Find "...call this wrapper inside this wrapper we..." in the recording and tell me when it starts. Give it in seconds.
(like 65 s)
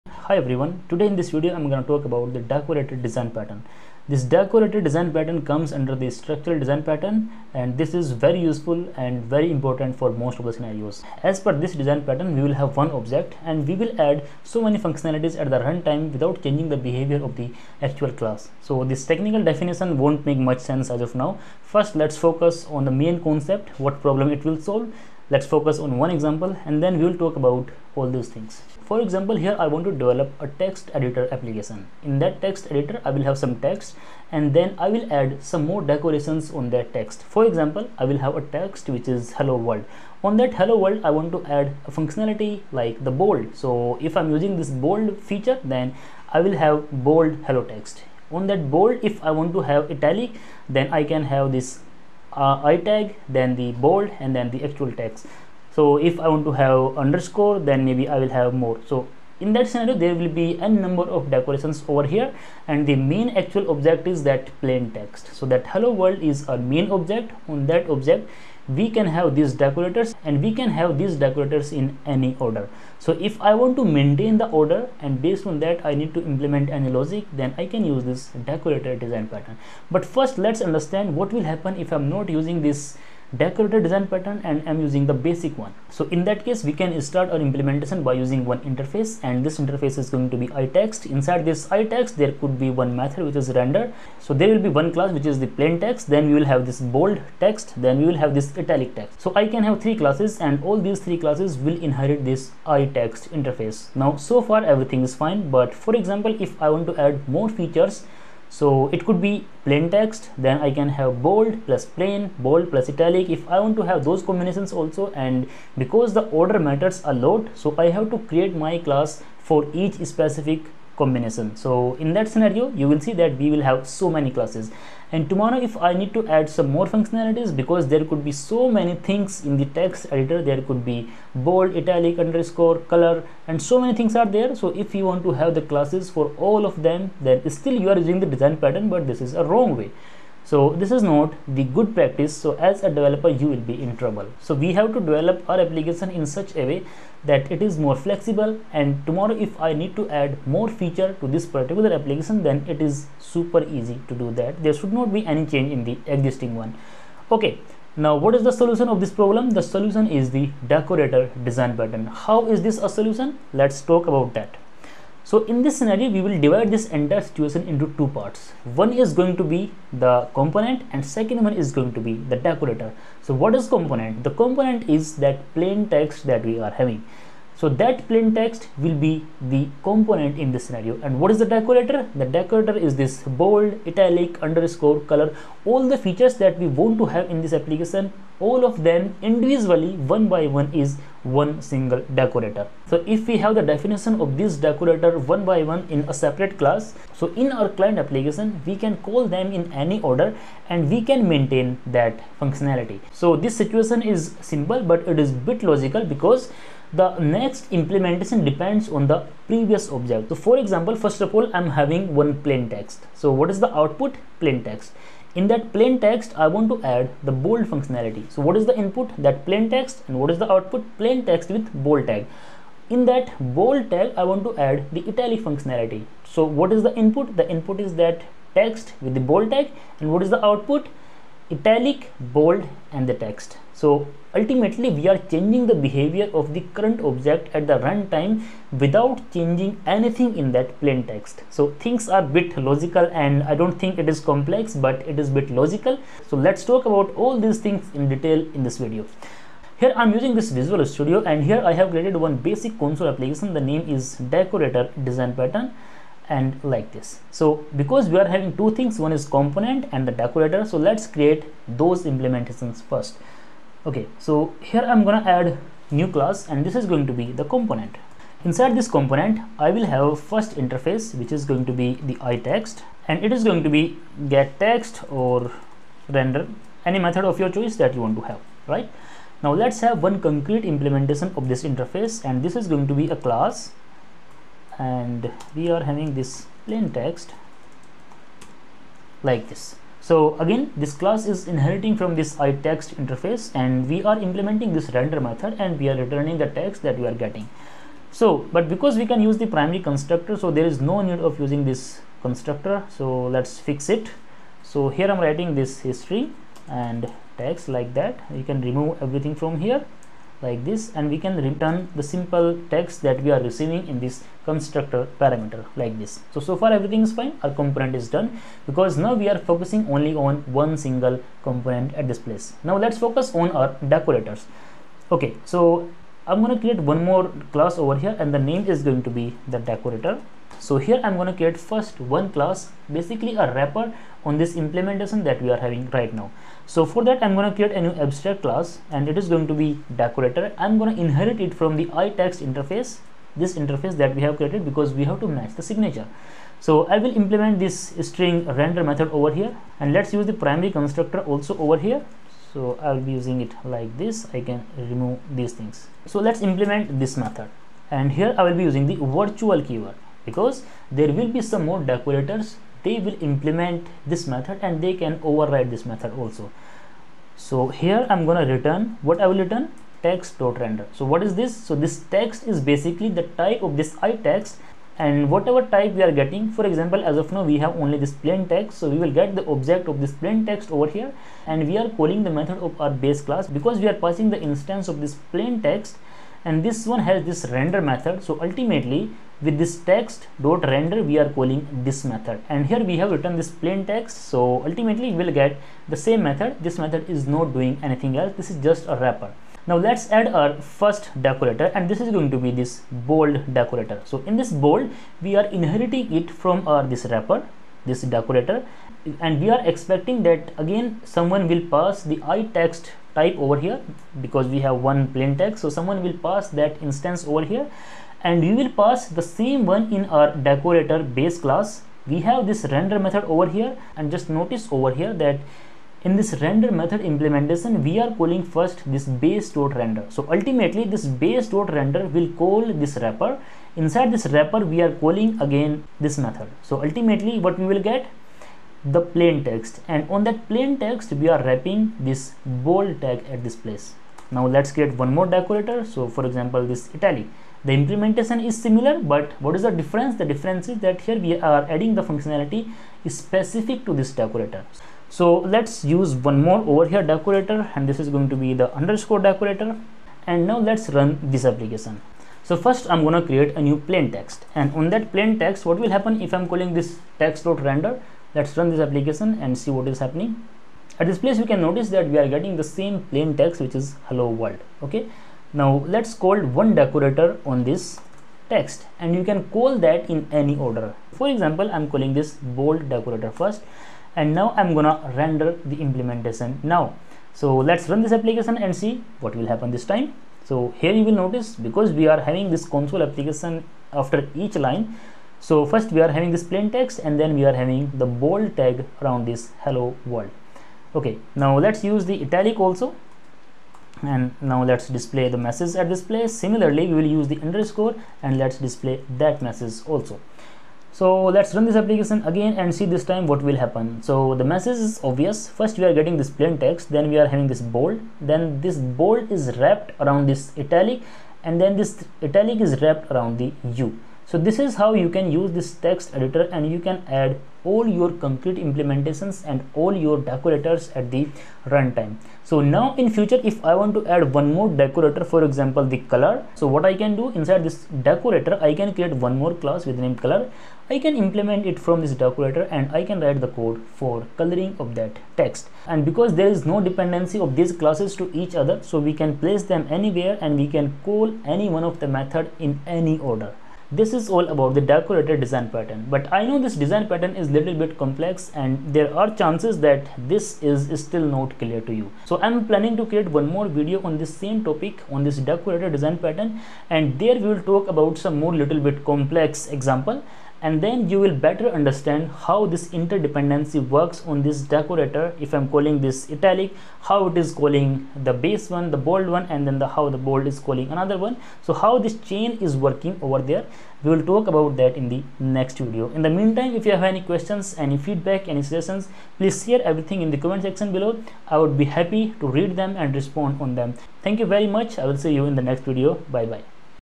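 432 s.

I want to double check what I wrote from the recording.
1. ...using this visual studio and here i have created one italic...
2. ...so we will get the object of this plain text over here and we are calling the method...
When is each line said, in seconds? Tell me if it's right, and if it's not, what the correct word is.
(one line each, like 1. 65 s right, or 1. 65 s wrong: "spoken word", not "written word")
1. 250 s wrong: "basic", not "italic"
2. 378 s right.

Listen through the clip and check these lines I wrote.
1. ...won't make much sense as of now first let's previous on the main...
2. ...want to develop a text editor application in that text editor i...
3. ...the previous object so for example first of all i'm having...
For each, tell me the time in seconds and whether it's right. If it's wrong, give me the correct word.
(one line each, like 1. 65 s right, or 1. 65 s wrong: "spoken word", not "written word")
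1. 19 s wrong: "focus", not "previous"
2. 29 s right
3. 209 s right.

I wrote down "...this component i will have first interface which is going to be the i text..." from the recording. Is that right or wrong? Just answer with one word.
right.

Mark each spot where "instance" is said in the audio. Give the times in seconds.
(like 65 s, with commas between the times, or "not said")
384 s, 416 s.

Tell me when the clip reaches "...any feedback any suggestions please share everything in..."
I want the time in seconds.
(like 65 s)
587 s.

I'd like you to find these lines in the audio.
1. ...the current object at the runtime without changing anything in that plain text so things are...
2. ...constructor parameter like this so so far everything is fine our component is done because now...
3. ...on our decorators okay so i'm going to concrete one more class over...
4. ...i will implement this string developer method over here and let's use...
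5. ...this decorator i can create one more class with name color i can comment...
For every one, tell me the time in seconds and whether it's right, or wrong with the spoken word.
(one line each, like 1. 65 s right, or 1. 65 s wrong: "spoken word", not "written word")
1. 236 s right
2. 314 s right
3. 323 s wrong: "create", not "concrete"
4. 346 s wrong: "render", not "developer"
5. 537 s wrong: "implement", not "comment".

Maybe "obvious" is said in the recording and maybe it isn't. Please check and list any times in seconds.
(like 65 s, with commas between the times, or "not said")
515 s.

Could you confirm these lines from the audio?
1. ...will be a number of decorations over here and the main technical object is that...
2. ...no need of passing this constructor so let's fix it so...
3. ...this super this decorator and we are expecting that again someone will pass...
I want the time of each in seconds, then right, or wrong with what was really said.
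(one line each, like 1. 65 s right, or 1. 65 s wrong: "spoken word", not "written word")
1. 60 s wrong: "actual", not "technical"
2. 300 s wrong: "using", not "passing"
3. 406 s wrong: "wrapper", not "super".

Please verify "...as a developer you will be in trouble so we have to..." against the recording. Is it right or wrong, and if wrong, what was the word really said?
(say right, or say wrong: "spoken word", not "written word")
right.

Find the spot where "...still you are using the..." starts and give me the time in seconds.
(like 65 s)
137 s.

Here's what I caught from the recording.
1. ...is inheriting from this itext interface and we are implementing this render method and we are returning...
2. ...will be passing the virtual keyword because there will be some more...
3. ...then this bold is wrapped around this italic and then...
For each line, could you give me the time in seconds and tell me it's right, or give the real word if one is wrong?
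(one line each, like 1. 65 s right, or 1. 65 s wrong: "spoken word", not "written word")
1. 291 s right
2. 358 s wrong: "using", not "passing"
3. 518 s right.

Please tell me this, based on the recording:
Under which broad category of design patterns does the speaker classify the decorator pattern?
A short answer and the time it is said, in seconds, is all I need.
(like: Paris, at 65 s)
Structural design pattern, at 6 s.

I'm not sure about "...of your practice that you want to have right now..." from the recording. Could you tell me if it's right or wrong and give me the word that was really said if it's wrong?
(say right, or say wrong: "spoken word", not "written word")
wrong: "choice", not "practice".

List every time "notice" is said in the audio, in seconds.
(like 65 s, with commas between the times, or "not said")
424 s, 471 s, 491 s.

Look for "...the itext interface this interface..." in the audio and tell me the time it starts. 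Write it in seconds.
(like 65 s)
341 s.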